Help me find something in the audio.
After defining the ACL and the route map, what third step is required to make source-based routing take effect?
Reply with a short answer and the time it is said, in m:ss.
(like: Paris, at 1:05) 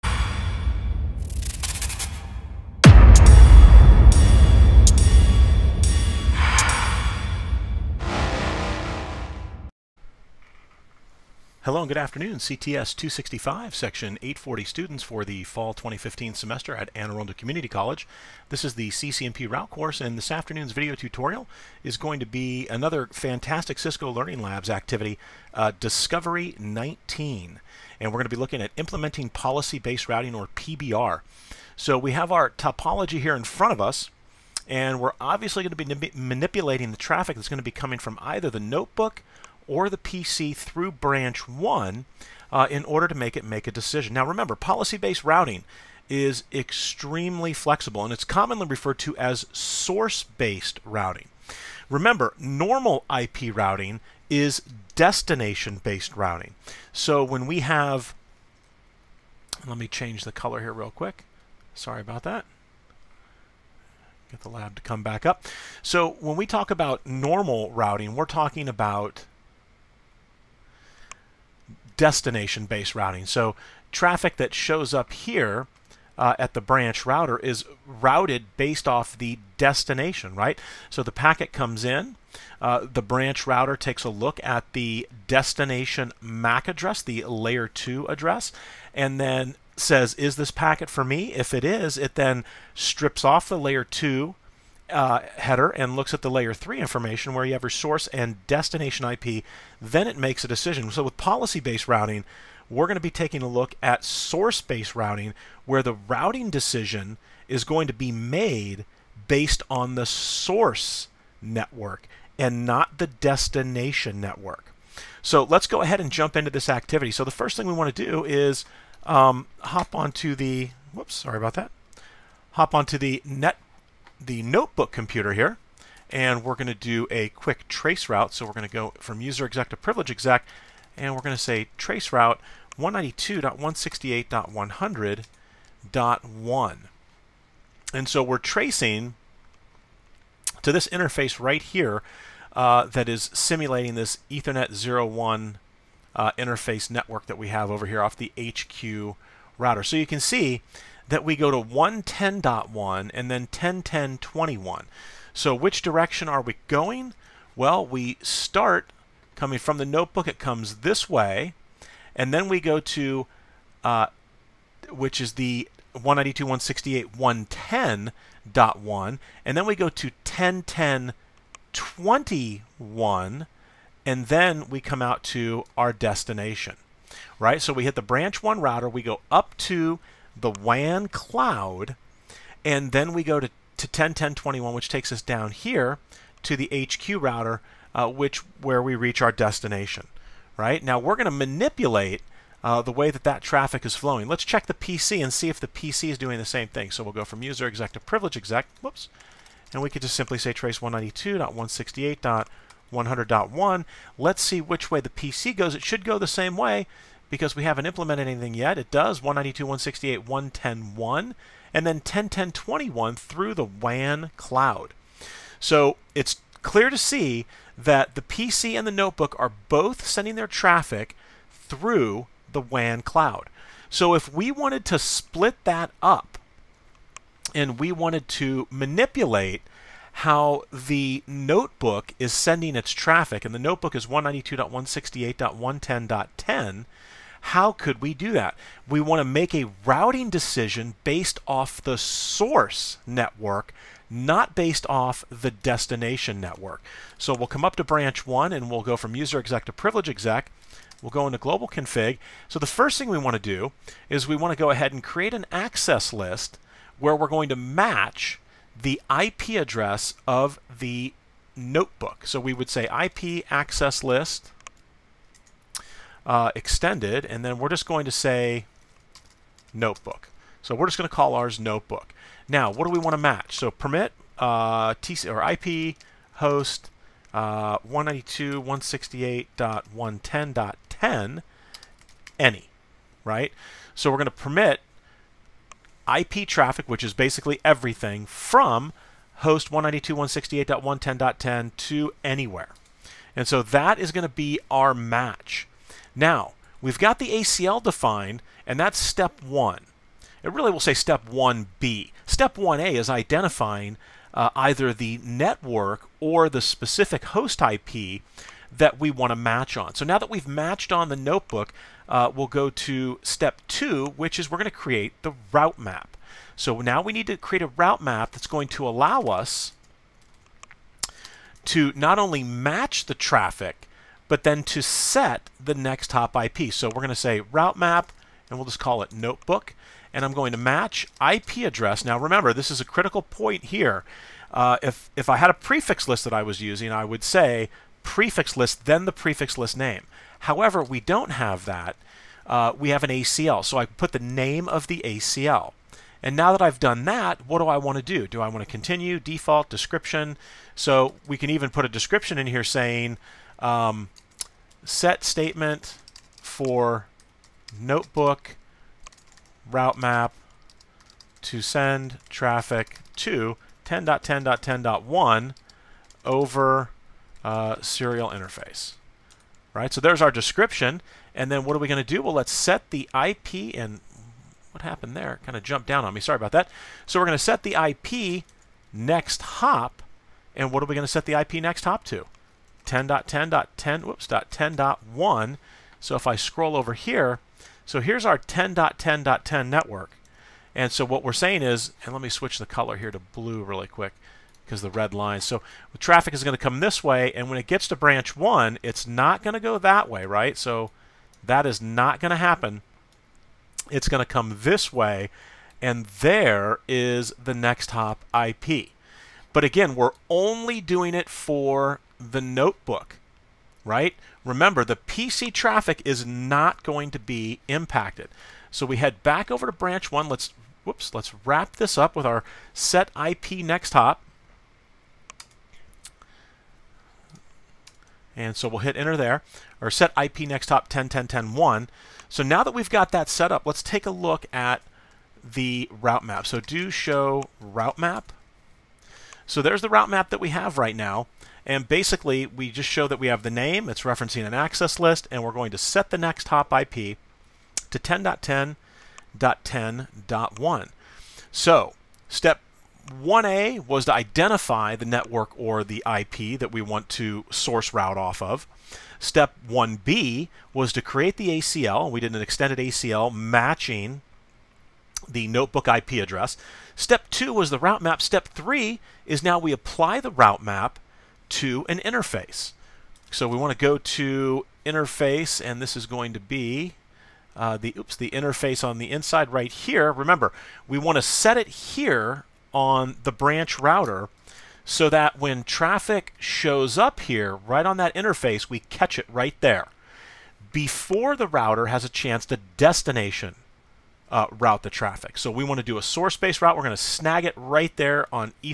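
Apply the route map to an interface, at 7:49.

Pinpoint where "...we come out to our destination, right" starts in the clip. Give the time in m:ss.
2:54.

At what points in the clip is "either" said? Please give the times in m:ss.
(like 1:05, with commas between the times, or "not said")
0:38, 5:04.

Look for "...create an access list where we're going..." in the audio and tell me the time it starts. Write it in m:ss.
4:15.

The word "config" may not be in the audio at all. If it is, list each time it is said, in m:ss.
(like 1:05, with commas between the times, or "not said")
4:11.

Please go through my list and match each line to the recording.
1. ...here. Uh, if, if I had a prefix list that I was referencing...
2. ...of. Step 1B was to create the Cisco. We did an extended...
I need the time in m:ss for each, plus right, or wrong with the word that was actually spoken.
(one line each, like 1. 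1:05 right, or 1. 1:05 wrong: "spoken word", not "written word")
1. 5:33 wrong: "using", not "referencing"
2. 7:38 wrong: "ACL", not "Cisco".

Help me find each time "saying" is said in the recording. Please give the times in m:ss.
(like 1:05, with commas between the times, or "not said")
5:52, 6:31.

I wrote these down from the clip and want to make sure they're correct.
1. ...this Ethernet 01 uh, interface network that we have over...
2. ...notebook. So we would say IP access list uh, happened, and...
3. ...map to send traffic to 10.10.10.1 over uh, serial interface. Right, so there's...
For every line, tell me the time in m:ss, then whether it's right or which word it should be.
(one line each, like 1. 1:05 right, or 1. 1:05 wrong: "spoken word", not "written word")
1. 2:23 right
2. 4:21 wrong: "extended", not "happened"
3. 5:59 right.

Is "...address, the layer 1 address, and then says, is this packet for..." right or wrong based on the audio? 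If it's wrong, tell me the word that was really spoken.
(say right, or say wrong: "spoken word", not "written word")
wrong: "2", not "1".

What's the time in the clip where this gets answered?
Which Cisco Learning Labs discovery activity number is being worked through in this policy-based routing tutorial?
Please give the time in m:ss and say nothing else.
0:25.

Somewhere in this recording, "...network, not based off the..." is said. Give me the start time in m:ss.
4:03.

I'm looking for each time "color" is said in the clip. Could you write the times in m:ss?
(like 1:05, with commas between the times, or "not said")
1:00, 6:32.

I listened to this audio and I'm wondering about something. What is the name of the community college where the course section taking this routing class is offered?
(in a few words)
Anne Arundel Community College.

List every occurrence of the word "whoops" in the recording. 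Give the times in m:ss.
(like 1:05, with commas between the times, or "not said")
2:00, 3:18, 6:24, 7:00.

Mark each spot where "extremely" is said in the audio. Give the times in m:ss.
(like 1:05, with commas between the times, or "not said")
0:46.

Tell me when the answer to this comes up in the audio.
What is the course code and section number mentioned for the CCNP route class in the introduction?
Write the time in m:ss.
0:12.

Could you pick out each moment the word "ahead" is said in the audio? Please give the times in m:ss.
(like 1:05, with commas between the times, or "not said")
1:55, 4:14.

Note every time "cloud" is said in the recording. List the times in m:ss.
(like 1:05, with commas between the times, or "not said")
3:01, 3:34, 3:43.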